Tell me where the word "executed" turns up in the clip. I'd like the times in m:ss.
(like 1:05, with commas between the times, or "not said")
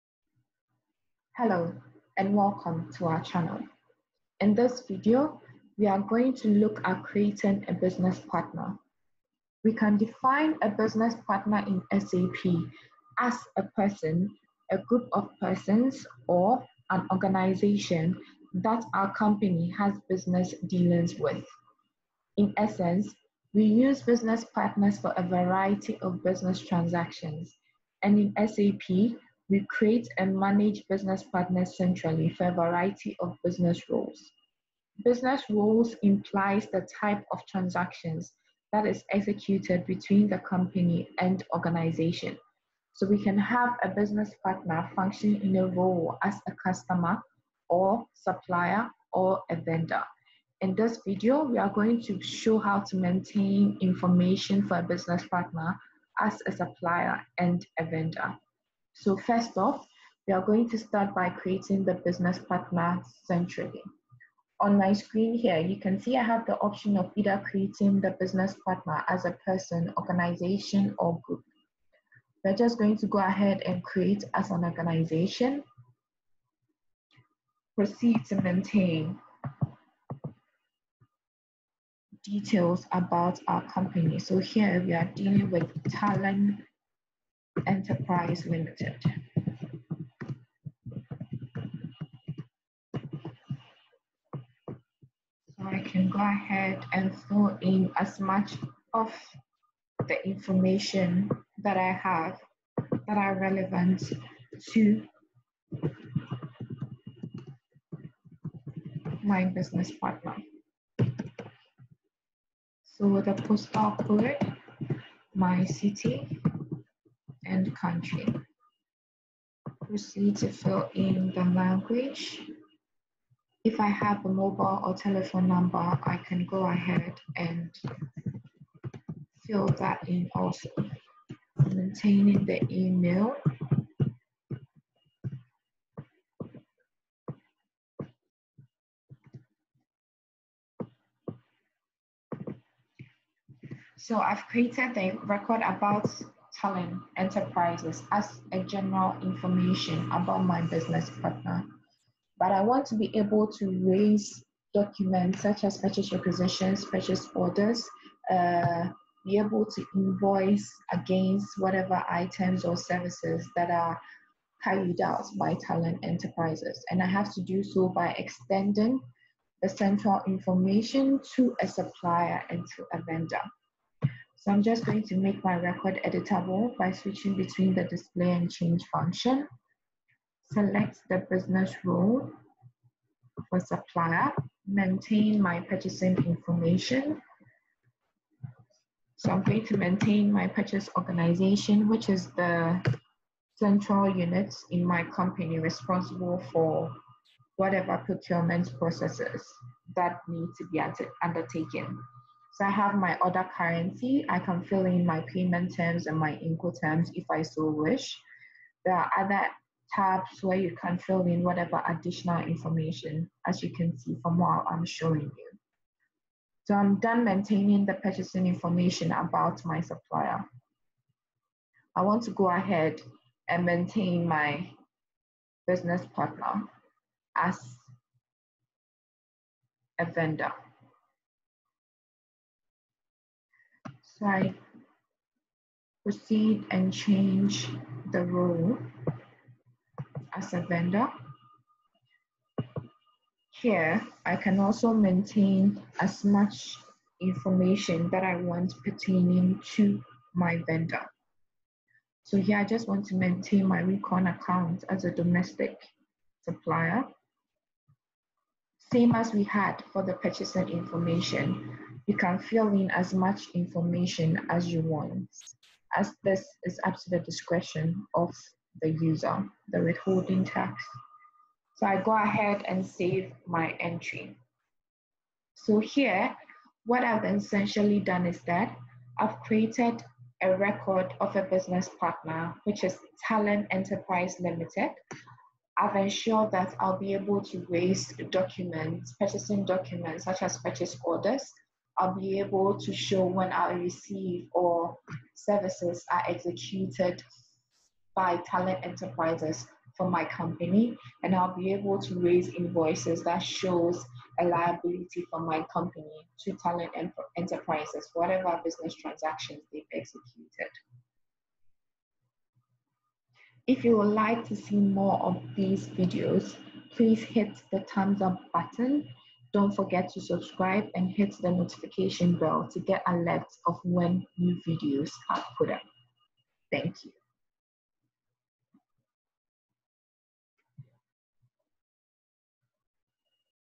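0:39, 4:56, 5:09.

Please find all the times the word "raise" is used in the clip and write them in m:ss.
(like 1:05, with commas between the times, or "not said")
2:33, 4:47, 5:02.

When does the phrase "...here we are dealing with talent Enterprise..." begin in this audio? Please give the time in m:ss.
1:24.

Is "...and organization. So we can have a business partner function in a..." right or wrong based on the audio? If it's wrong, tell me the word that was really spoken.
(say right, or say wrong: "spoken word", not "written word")
right.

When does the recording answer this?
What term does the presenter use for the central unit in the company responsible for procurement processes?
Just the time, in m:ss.
3:10.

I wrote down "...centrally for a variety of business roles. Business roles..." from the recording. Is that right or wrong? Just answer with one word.
right.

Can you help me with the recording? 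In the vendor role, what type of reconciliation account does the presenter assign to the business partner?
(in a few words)
Domestic supplier.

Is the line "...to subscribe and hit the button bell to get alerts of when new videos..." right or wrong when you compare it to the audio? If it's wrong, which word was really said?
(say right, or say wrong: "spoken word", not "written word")
wrong: "notification", not "button".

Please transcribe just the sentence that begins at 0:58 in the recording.
So first off, we are going to start by creating the business partner centrally.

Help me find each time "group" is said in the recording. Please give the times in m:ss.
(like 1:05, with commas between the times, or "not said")
0:14, 1:11.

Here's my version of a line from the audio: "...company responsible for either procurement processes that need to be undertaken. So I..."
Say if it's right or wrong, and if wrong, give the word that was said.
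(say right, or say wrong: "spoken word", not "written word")
wrong: "whatever", not "either".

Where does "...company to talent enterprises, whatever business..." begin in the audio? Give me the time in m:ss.
5:05.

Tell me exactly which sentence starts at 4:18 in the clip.
Same as we had for the purchasing information.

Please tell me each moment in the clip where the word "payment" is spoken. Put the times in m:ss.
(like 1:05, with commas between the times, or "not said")
3:25.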